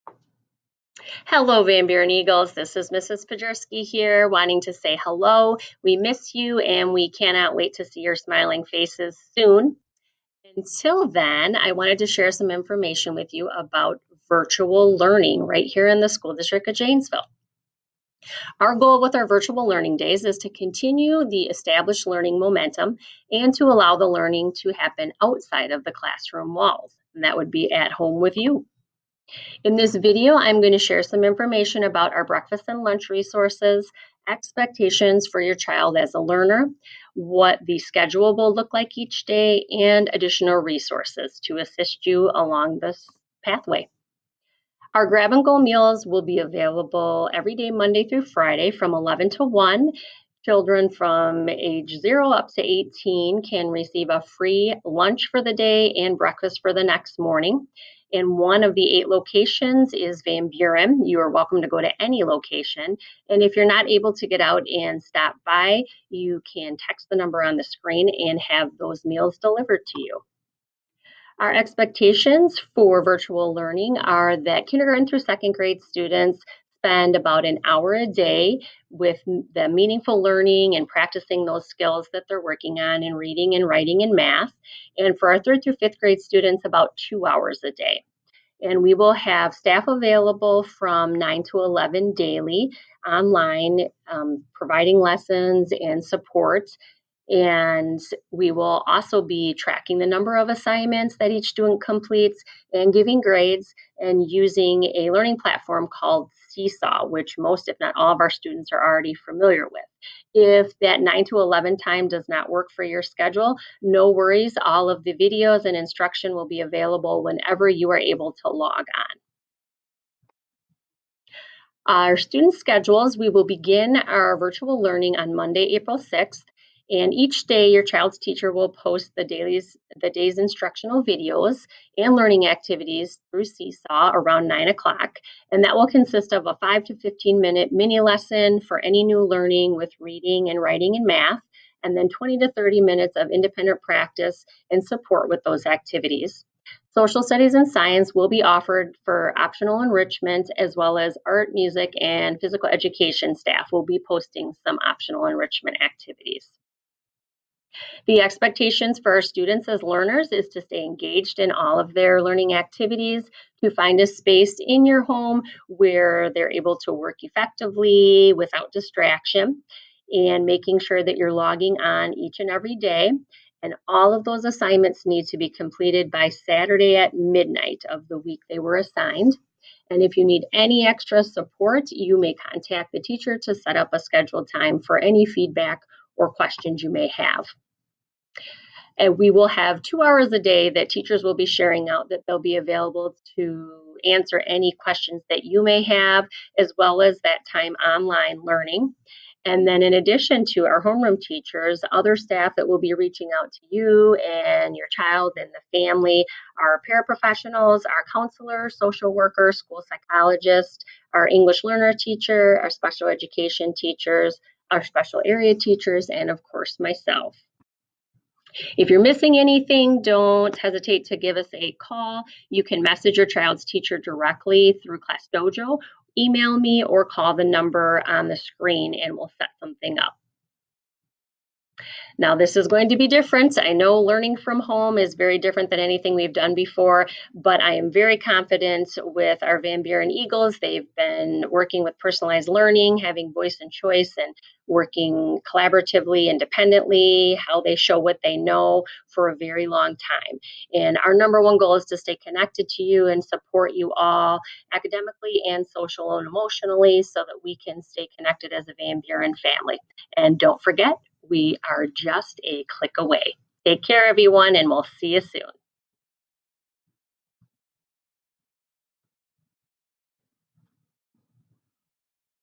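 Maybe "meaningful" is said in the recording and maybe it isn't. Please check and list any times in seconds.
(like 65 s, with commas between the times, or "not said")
79 s.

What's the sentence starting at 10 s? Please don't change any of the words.
Until then, I wanted to share some information with you about virtual learning right here in the School District of Janesville.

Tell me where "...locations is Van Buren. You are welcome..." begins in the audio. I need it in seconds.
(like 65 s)
59 s.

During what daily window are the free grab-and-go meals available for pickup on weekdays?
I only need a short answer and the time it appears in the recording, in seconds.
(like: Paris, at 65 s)
11 to 1, at 48 s.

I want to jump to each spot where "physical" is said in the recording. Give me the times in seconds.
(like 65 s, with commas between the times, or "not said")
152 s.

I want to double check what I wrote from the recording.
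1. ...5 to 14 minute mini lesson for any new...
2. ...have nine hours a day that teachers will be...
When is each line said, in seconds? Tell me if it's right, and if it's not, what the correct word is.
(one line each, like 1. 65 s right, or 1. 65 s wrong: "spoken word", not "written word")
1. 136 s wrong: "15", not "14"
2. 189 s wrong: "two", not "nine".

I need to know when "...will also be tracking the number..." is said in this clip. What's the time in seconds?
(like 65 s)
98 s.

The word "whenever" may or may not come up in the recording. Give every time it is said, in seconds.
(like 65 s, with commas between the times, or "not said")
117 s.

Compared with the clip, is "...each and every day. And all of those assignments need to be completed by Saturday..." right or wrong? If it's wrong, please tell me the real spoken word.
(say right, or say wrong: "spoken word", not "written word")
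right.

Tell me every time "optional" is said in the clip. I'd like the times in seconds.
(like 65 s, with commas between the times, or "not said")
149 s, 154 s.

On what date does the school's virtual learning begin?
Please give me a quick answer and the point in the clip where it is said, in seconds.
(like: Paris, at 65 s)
Monday, April 6th, at 125 s.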